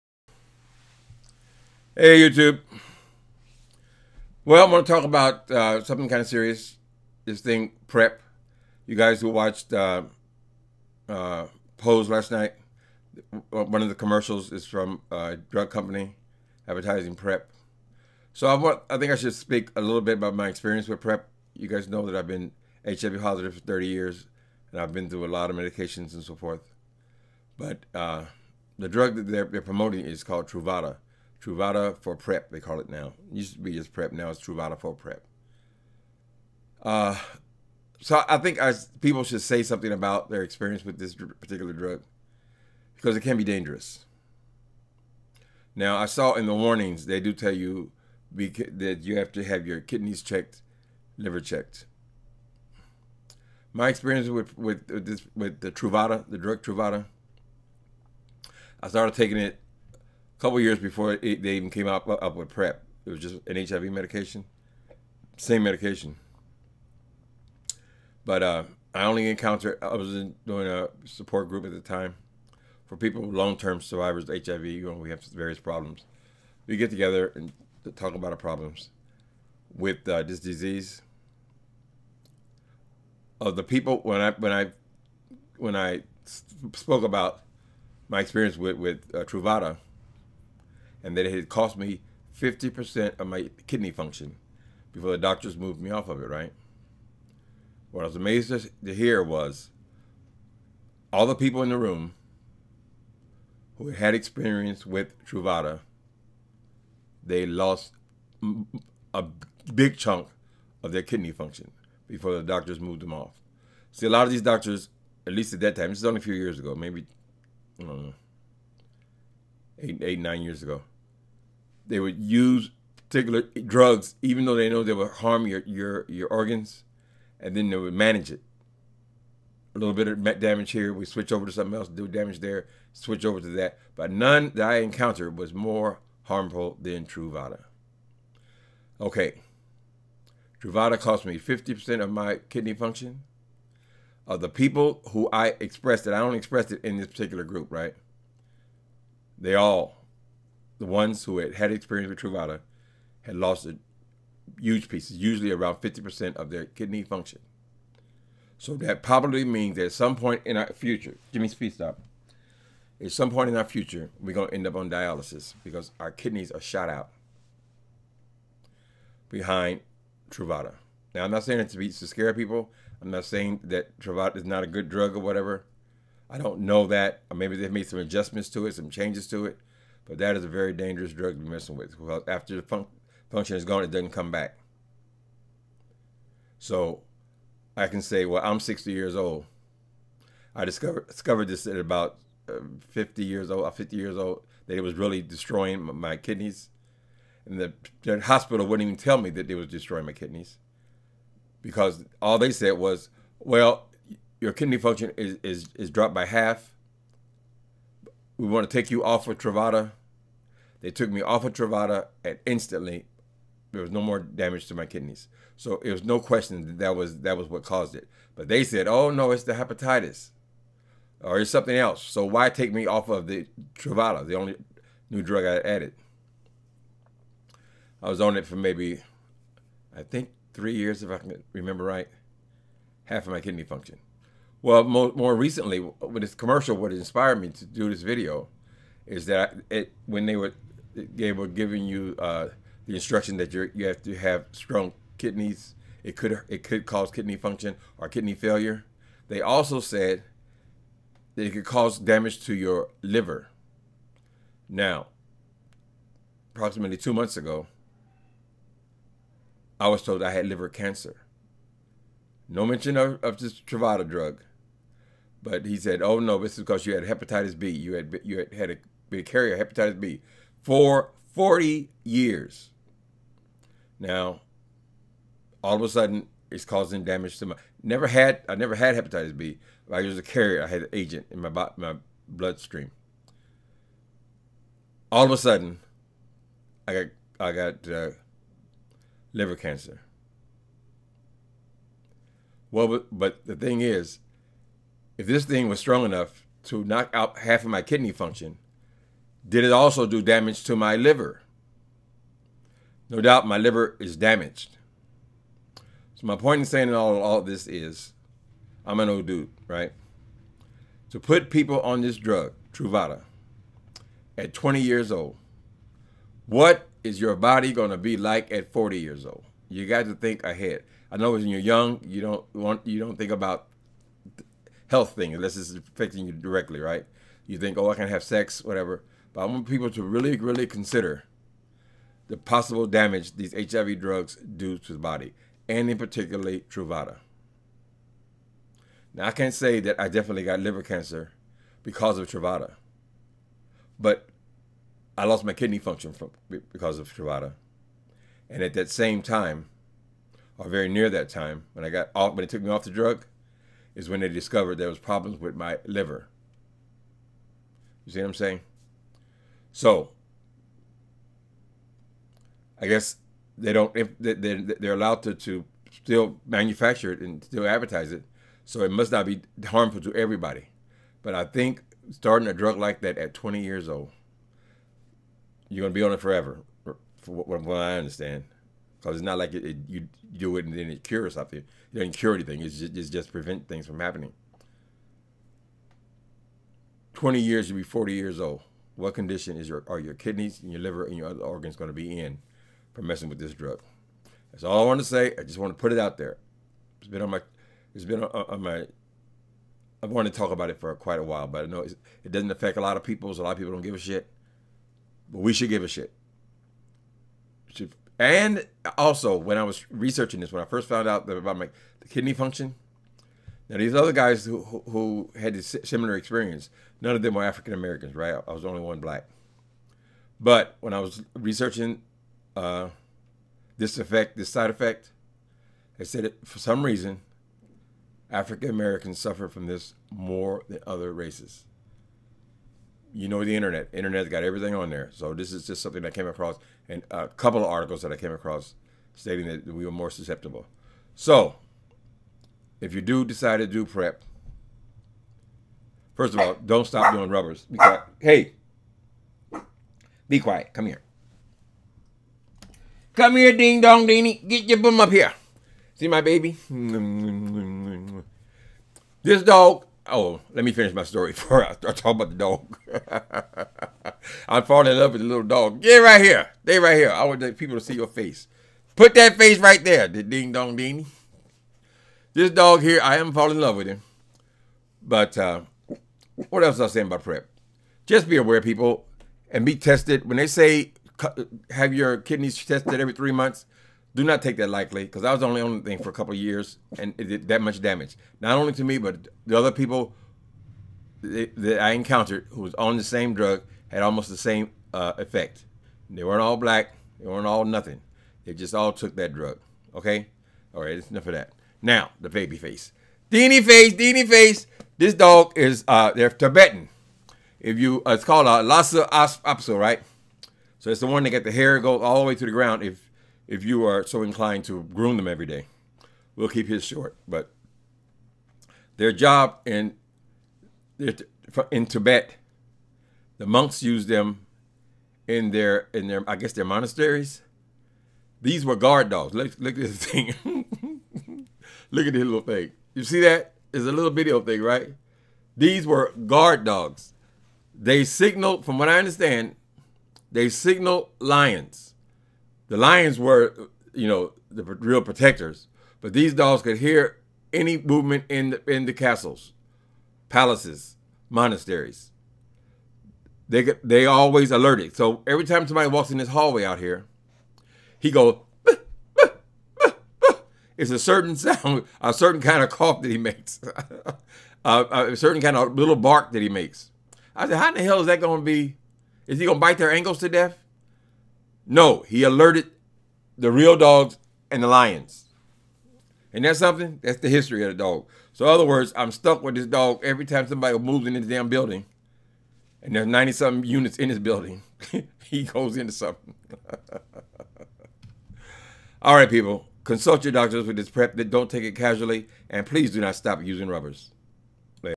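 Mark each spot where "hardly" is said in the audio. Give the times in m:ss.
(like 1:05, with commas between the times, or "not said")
not said.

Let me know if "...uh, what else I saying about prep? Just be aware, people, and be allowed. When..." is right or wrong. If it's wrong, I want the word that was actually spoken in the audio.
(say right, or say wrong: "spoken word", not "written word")
wrong: "tested", not "allowed".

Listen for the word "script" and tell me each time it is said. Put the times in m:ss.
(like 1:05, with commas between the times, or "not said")
not said.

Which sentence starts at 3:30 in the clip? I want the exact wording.
They took me off of Truvada and instantly there was no more damage to my kidneys.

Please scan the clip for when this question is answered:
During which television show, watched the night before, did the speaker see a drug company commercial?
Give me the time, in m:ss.
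0:11.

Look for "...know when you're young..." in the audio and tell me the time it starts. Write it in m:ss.
5:21.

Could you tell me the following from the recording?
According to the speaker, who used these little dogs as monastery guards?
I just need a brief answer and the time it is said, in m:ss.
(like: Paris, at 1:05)
The monks, at 8:43.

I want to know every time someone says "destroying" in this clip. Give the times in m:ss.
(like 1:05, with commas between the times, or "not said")
3:15, 3:19.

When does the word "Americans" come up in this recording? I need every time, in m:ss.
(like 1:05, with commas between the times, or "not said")
6:57, 7:08.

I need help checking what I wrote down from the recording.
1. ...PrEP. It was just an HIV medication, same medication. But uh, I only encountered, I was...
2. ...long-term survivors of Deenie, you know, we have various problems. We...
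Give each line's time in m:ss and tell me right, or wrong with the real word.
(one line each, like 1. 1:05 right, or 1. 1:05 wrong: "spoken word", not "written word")
1. 1:02 right
2. 1:13 wrong: "HIV", not "Deenie".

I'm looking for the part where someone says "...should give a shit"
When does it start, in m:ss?
6:45.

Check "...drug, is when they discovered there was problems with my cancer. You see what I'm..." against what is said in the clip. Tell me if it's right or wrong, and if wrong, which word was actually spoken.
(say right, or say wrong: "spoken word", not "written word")
wrong: "liver", not "cancer".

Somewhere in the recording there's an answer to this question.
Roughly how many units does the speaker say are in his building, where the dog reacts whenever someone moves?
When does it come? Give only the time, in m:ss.
9:43.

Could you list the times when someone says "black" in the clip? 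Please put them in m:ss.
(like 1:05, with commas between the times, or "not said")
6:58, 8:16.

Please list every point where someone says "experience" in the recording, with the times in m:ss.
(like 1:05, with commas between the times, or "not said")
0:20, 0:40, 0:53, 1:28, 1:44, 2:31, 6:56.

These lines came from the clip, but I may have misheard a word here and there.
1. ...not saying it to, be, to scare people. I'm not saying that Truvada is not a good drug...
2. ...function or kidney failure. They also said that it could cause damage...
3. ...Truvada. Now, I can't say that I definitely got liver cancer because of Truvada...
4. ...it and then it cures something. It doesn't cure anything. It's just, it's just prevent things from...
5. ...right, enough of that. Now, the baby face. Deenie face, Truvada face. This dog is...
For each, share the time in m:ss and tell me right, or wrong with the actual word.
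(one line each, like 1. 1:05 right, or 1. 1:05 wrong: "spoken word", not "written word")
1. 2:51 right
2. 4:07 right
3. 5:36 right
4. 6:20 right
5. 8:20 wrong: "Deenie", not "Truvada".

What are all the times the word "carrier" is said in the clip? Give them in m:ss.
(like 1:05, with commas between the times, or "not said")
4:29, 4:40.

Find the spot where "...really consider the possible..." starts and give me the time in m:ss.
5:30.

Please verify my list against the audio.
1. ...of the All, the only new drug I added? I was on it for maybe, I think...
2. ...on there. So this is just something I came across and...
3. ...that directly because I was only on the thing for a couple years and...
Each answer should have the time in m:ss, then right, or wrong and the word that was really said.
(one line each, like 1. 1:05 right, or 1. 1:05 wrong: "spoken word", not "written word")
1. 3:43 wrong: "Truvada", not "All"
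2. 7:14 right
3. 8:04 wrong: "lightly", not "directly".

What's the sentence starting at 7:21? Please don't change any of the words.
So if you do decide to do prep, first of all, don't stop doing rubbers.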